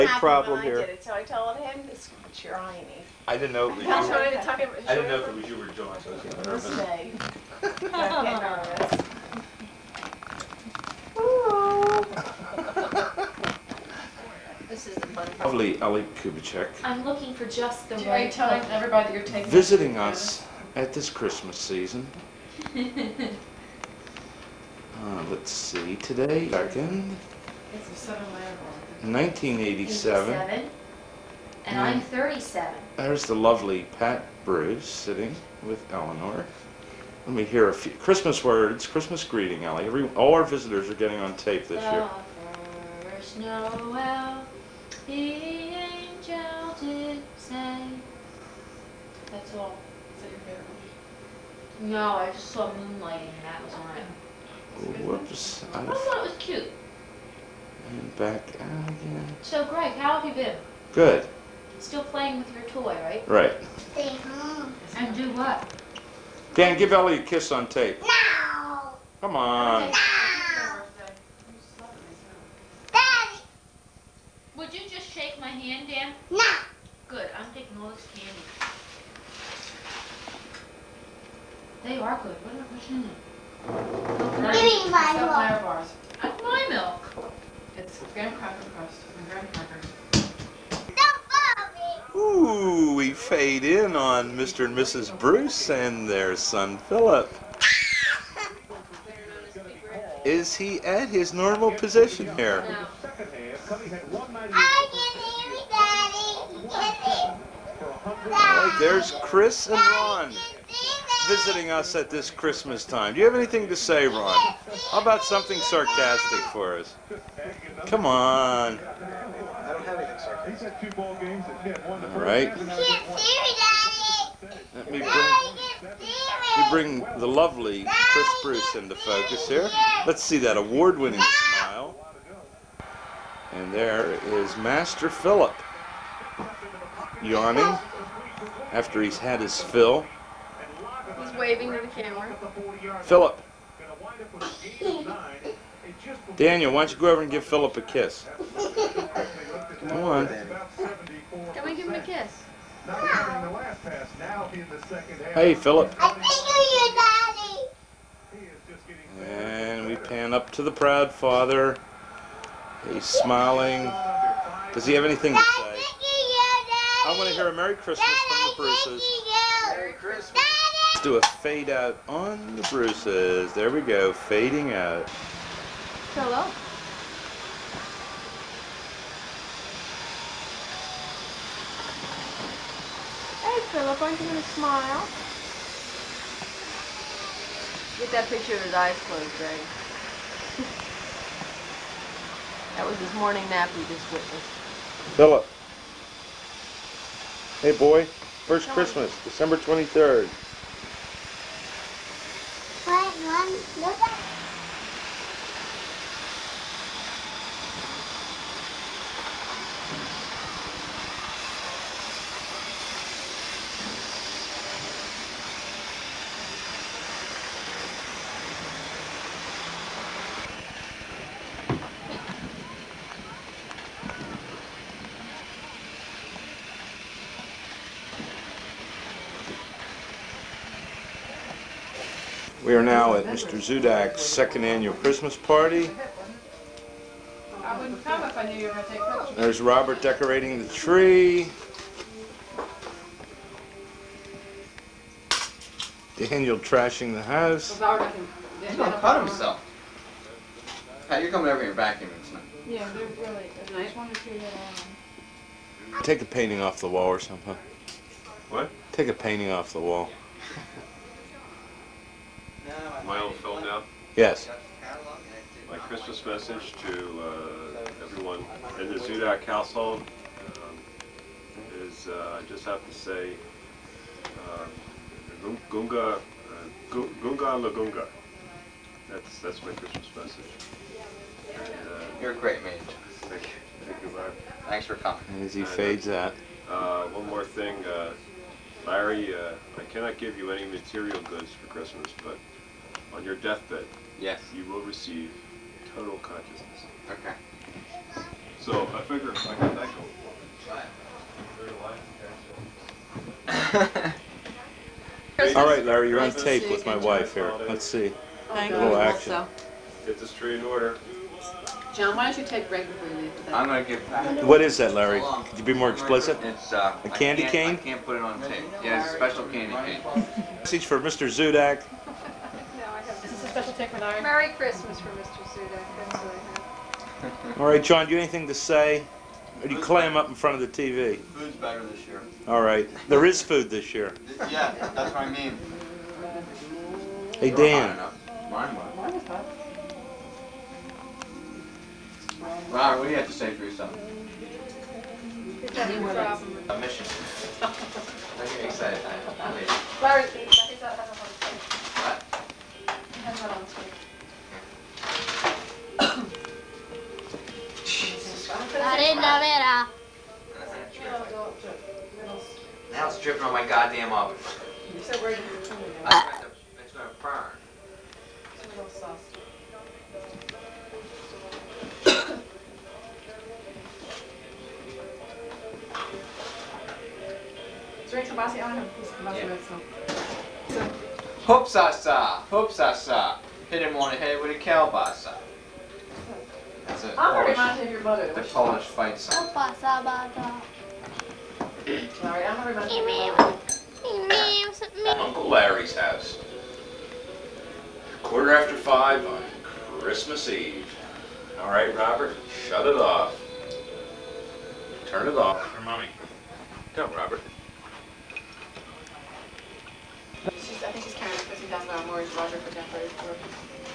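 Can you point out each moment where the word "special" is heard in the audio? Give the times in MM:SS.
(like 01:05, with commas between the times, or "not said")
05:19, 05:23.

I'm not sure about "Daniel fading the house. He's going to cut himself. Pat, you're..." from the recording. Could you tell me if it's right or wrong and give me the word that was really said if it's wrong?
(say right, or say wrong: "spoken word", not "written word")
wrong: "trashing", not "fading".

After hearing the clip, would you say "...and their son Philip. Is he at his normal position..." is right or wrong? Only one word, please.
right.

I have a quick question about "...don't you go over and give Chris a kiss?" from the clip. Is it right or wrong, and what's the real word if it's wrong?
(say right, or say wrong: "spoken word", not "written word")
wrong: "Philip", not "Chris".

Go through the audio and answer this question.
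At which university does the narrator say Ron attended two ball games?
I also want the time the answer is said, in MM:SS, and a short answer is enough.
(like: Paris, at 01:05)
Pitt, at 02:01.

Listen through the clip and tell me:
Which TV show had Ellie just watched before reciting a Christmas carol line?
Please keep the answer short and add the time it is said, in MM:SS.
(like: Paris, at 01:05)
Moonlighting, at 00:52.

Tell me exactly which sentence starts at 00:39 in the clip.
Every, all our visitors are getting on tape this year.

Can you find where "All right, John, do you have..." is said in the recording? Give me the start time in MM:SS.
05:27.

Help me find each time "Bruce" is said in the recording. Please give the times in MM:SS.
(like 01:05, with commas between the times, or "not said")
00:34, 01:35, 02:08, 02:48, 02:52.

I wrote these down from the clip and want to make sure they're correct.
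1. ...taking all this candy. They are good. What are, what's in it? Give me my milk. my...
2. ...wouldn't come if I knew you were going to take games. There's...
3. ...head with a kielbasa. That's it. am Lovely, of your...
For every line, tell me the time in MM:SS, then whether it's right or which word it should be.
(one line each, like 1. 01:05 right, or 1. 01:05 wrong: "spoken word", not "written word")
1. 01:17 right
2. 03:57 wrong: "pictures", not "games"
3. 06:24 wrong: "Polish", not "Lovely".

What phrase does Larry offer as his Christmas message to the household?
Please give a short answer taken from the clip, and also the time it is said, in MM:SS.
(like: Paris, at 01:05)
Gunga Lagunga, at 04:36.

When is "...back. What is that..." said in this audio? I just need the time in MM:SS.
05:14.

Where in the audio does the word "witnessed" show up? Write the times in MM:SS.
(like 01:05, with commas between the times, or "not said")
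03:14.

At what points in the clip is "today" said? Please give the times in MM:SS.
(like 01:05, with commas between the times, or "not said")
00:25.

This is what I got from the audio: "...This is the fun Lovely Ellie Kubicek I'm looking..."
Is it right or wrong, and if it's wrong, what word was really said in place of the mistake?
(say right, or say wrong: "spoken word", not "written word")
right.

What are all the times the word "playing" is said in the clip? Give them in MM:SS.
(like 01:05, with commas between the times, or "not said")
01:02.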